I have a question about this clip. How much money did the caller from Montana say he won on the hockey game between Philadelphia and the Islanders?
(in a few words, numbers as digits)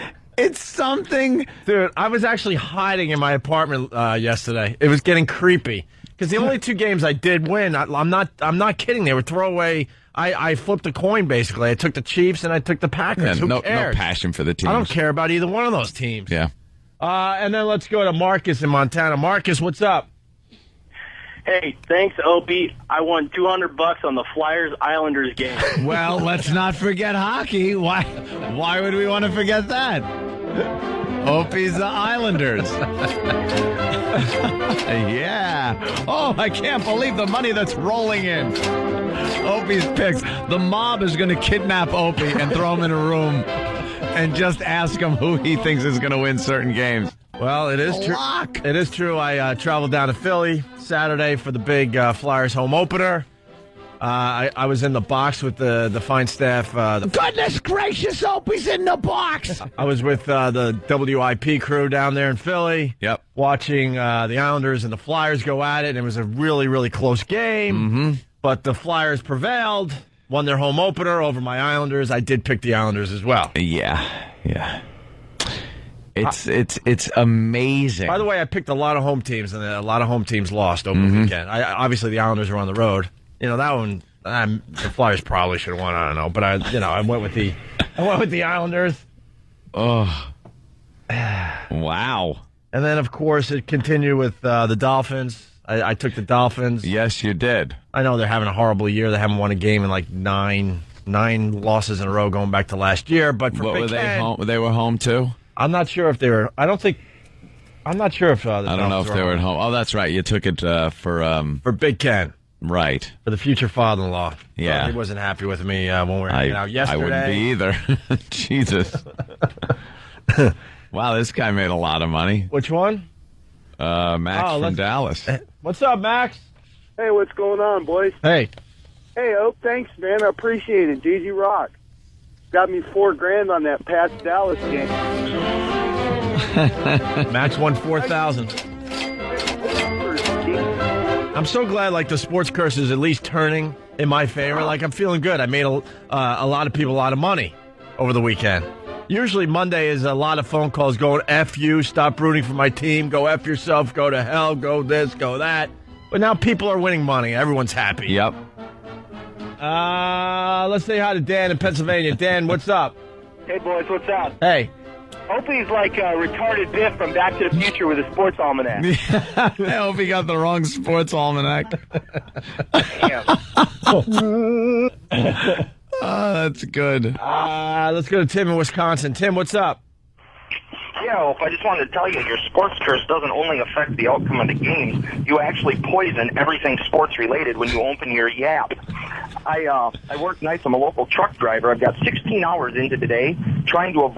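$200.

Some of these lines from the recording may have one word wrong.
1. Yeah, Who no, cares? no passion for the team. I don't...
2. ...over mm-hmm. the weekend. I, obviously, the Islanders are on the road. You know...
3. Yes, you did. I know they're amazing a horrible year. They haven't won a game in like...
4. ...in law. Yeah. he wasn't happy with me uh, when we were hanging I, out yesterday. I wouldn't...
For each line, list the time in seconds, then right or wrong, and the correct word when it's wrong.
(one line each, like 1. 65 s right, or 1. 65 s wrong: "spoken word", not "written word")
1. 13 s right
2. 80 s right
3. 96 s wrong: "having", not "amazing"
4. 114 s right.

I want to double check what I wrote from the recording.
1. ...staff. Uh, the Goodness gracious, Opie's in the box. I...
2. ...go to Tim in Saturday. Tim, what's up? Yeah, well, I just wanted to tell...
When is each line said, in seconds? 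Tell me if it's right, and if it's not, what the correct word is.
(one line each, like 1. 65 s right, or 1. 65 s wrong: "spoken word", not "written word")
1. 56 s right
2. 178 s wrong: "Wisconsin", not "Saturday".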